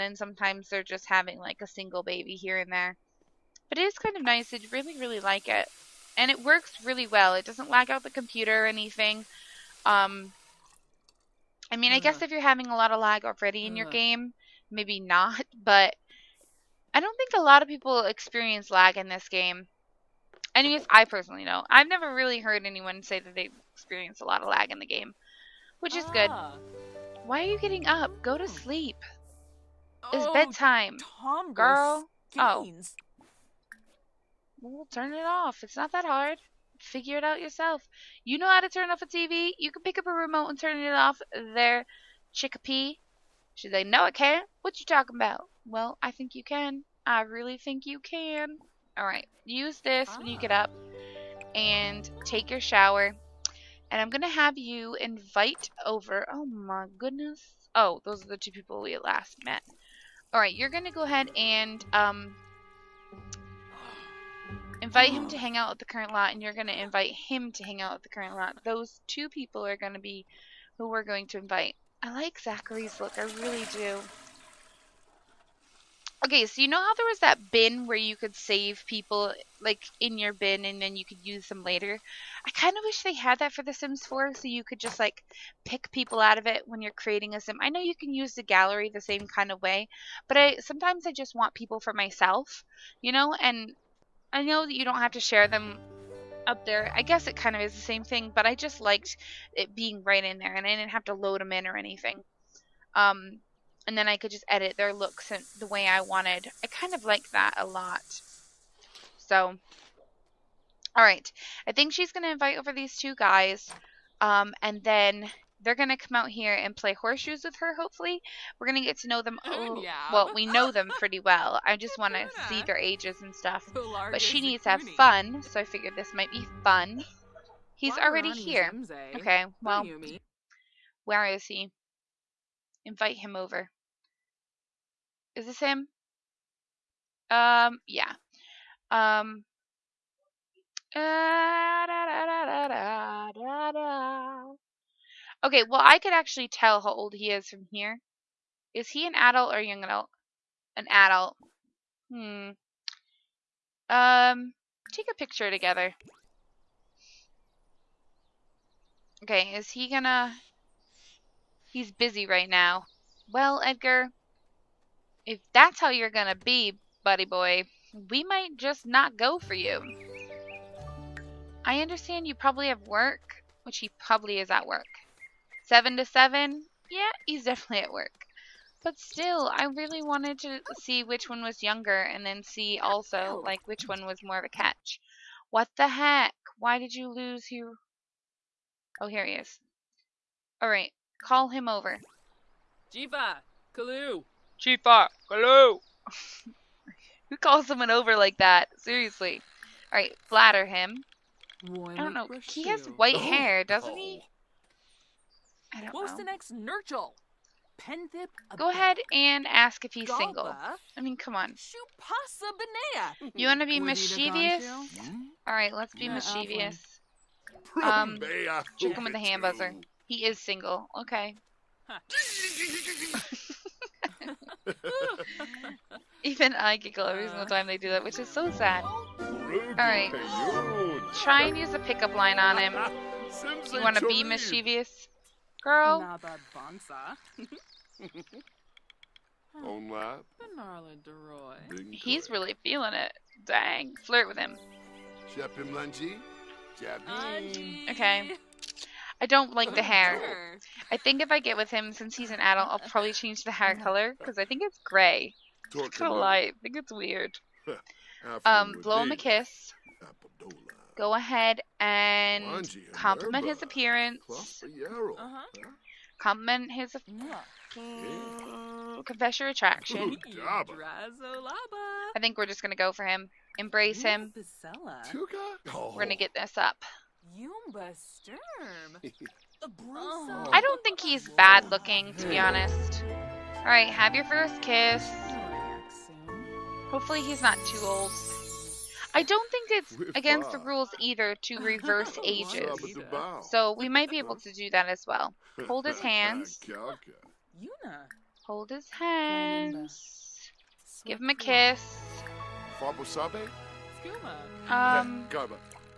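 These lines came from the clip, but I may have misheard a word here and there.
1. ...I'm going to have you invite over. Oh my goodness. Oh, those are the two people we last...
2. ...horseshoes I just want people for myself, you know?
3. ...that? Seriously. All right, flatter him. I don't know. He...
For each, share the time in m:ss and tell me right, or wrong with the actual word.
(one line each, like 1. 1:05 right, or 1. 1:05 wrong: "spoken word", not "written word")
1. 0:54 right
2. 1:30 wrong: "sometimes", not "horseshoes"
3. 3:18 right.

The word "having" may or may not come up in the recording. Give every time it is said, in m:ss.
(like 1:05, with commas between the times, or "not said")
0:01, 0:12.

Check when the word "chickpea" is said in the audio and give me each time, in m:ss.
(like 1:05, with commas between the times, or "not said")
0:42.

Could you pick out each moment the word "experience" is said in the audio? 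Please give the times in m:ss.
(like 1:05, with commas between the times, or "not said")
0:18, 0:23.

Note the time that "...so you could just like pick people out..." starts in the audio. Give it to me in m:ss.
1:24.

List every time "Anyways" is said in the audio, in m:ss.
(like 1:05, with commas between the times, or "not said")
0:20.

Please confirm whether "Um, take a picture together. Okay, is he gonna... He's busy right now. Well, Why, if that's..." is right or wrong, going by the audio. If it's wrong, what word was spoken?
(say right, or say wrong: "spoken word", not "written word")
wrong: "Edgar", not "Why".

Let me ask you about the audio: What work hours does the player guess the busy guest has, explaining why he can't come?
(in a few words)
7 to 7.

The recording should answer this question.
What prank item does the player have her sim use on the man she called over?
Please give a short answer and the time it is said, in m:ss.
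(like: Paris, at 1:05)
hand buzzer, at 3:39.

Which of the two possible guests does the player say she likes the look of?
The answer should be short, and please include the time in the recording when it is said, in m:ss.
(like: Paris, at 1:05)
Zachary, at 1:12.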